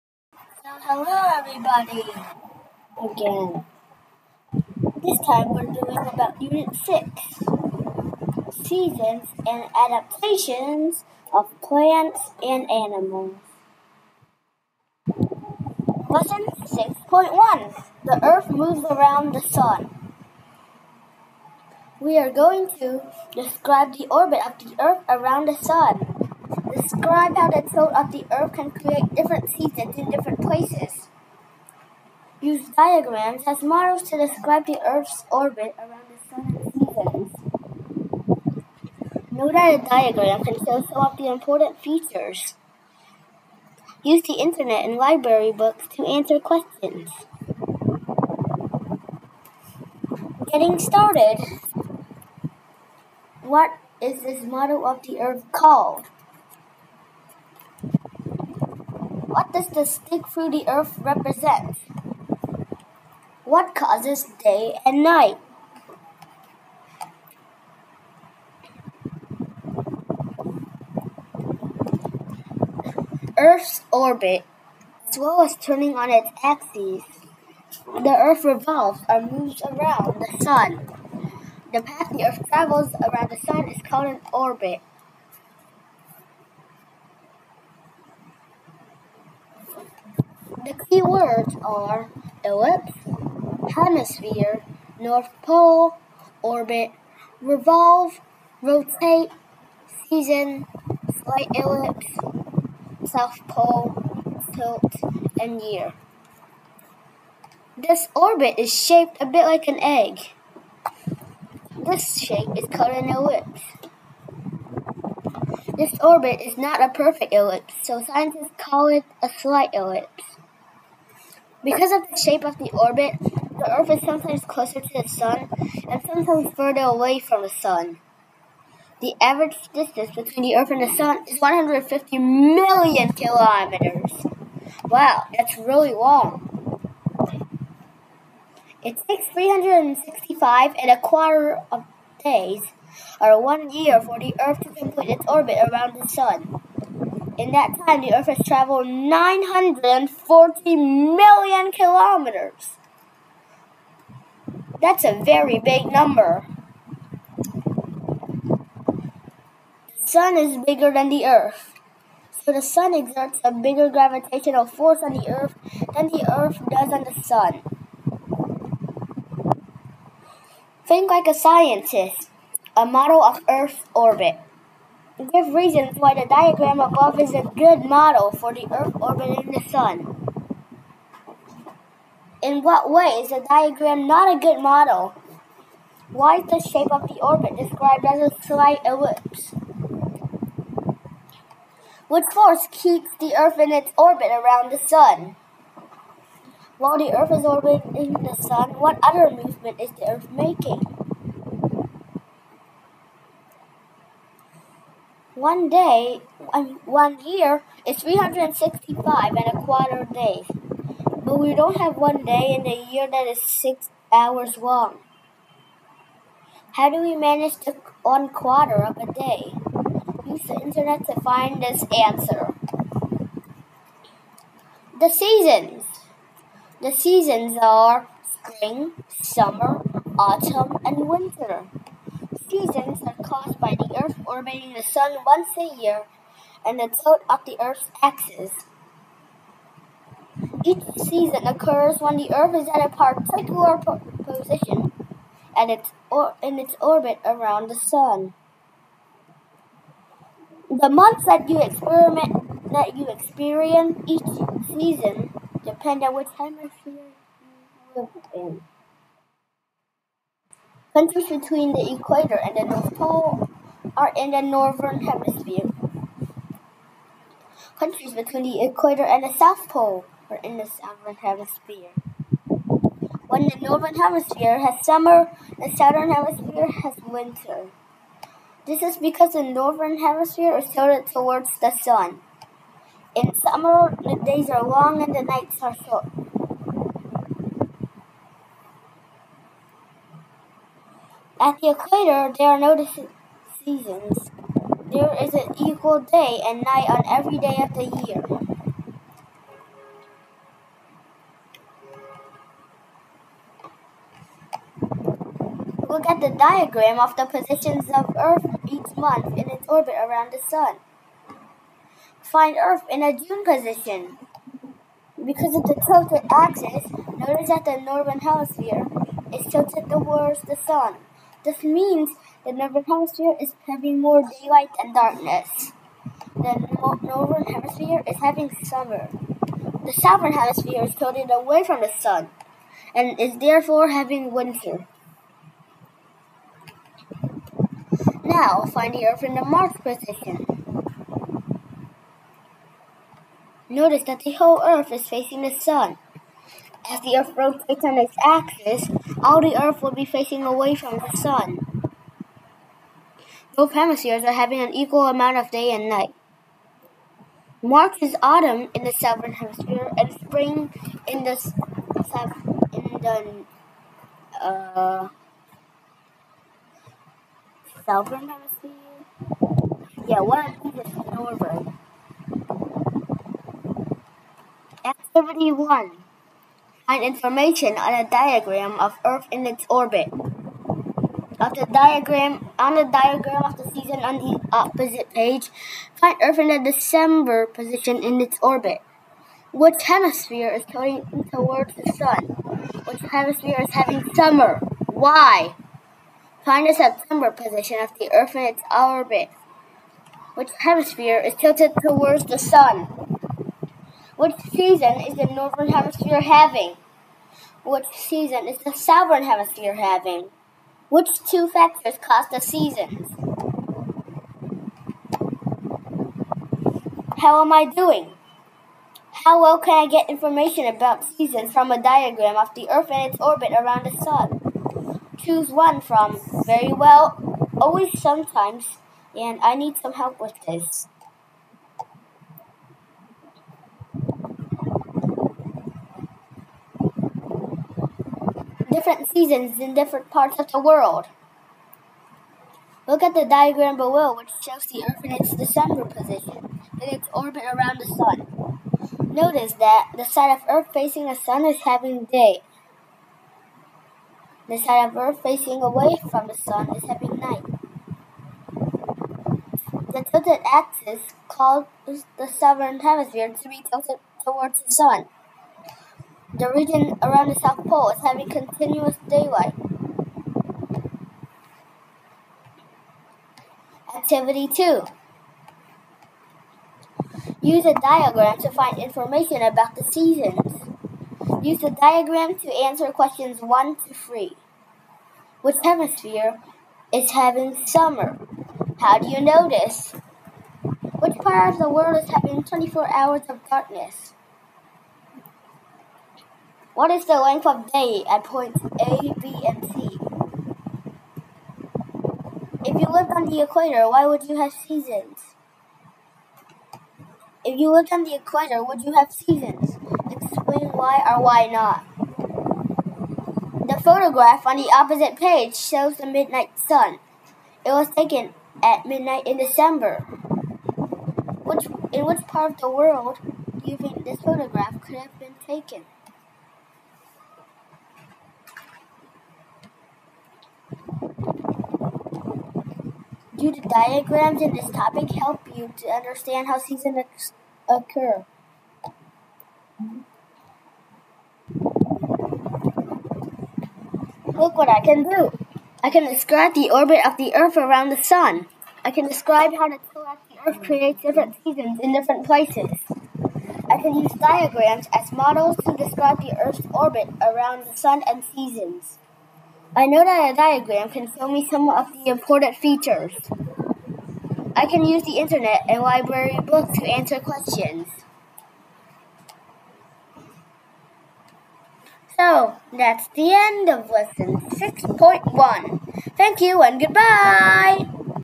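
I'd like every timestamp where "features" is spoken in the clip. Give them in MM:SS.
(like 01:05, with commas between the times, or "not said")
00:41, 09:22.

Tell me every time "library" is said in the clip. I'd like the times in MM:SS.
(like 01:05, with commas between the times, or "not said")
00:44, 09:25.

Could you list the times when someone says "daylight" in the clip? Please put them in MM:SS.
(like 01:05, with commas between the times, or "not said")
05:24, 07:49.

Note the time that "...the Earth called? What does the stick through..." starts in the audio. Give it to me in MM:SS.
00:55.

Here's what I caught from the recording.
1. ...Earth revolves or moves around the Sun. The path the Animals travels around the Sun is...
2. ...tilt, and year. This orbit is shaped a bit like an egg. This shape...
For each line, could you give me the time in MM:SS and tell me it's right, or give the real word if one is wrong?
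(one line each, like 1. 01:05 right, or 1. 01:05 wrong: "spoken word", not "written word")
1. 01:18 wrong: "Earth", not "Animals"
2. 01:44 right.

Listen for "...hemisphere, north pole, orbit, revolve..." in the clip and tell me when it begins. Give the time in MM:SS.
01:33.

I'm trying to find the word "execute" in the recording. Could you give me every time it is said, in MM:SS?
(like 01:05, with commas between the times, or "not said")
not said.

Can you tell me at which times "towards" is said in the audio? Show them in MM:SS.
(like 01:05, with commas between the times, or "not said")
04:41, 05:19, 06:31, 06:41, 07:44.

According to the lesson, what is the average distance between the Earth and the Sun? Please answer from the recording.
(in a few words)
150 million kilometers.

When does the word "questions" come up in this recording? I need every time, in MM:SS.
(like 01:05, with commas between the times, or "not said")
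00:46, 08:02, 09:27.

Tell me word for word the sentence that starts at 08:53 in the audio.
Do the diagrams in this topic help you to understand how seasons occur?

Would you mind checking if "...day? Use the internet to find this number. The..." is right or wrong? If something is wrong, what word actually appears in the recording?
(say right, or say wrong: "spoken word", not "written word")
wrong: "answer", not "number".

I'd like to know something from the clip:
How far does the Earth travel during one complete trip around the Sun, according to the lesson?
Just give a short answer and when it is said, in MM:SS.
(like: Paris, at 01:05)
940 million kilometers, at 02:28.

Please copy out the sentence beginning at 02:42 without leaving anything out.
So the Sun exerts a bigger gravitational force on the Earth than the Earth does on the Sun.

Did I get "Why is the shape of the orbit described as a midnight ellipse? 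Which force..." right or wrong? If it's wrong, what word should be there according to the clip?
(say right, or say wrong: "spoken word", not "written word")
wrong: "slight", not "midnight".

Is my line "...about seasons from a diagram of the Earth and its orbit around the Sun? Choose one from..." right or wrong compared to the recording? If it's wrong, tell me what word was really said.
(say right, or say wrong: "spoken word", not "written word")
right.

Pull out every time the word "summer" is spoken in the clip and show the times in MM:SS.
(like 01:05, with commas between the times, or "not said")
03:49, 04:34, 04:43, 05:28, 06:34, 08:07.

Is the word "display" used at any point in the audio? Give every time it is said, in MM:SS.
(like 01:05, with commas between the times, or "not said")
not said.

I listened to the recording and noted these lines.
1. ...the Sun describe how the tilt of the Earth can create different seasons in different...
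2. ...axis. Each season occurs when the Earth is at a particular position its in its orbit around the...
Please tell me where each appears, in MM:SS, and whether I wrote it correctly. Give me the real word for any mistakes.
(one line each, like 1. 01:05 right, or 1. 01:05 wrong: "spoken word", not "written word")
1. 00:25 right
2. 03:58 right.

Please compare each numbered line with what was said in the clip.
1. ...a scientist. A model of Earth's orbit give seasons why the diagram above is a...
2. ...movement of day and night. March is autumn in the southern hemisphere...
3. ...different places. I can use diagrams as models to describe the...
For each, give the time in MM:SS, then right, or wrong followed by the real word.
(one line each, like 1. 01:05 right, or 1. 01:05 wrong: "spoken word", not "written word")
1. 02:51 wrong: "reasons", not "seasons"
2. 05:55 wrong: "amount", not "movement"
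3. 09:11 right.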